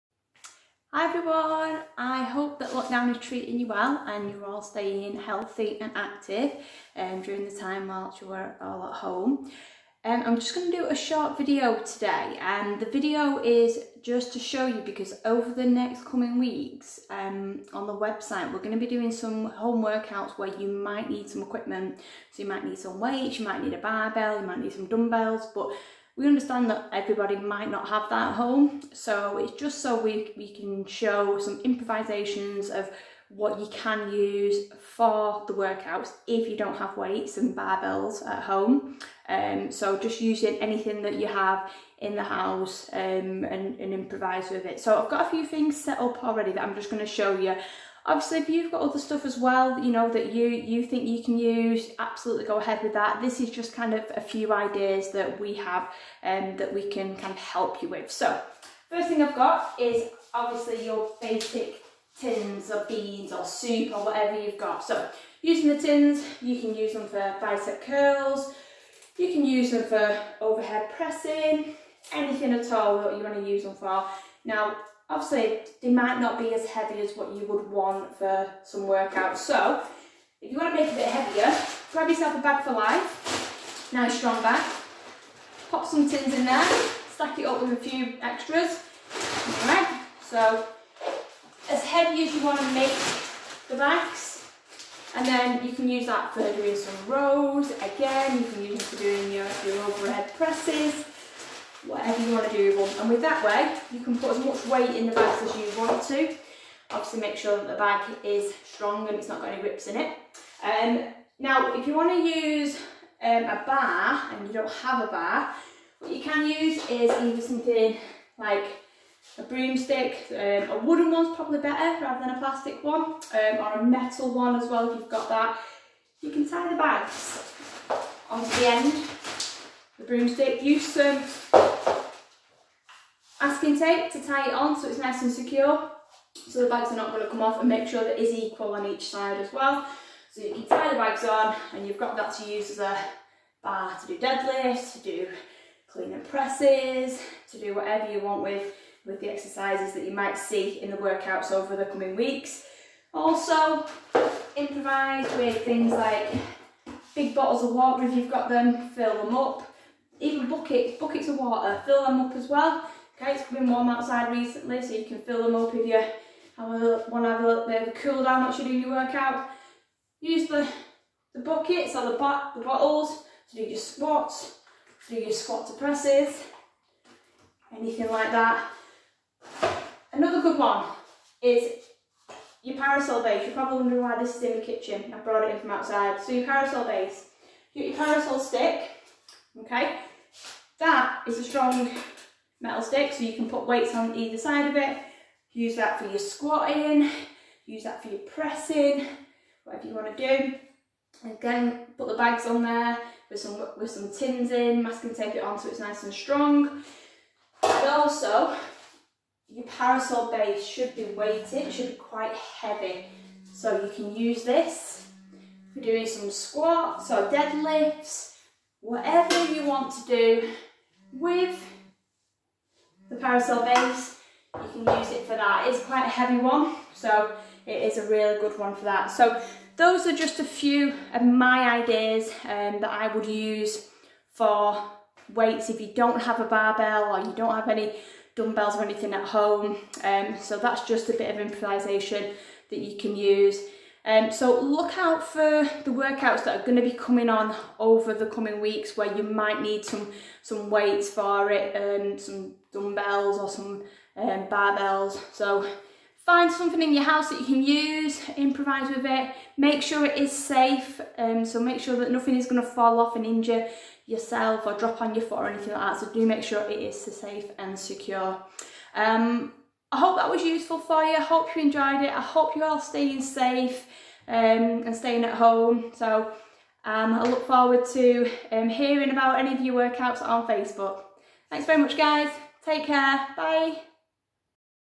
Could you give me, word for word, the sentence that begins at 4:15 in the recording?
So find something in your house that you can use, improvise with it, make sure it is safe.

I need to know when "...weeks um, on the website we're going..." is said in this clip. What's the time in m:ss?
0:16.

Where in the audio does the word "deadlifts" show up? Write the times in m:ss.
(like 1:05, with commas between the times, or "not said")
2:24, 3:37.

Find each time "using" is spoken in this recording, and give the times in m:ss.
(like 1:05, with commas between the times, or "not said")
0:40, 1:05.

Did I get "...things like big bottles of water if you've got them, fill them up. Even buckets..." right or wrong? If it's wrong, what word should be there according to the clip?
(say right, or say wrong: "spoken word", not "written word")
right.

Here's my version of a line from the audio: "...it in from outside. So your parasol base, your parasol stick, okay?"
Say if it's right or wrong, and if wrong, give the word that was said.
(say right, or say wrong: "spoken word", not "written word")
right.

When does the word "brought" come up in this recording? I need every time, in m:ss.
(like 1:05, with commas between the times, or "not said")
3:05.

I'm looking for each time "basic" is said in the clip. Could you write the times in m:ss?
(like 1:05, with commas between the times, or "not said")
1:01.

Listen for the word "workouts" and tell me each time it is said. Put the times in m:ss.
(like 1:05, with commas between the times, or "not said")
0:19, 0:35, 1:18, 2:30, 2:48, 4:05, 4:39.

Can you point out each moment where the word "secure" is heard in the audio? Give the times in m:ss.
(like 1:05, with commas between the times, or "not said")
2:15, 4:27.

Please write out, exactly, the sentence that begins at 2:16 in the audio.
So the bags are not going to come off and make sure that is equal on each side as well.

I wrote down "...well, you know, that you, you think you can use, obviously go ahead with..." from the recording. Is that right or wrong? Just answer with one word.
wrong.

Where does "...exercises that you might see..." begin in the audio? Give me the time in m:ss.
2:29.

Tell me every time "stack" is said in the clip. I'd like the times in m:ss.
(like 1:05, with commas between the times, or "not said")
1:27.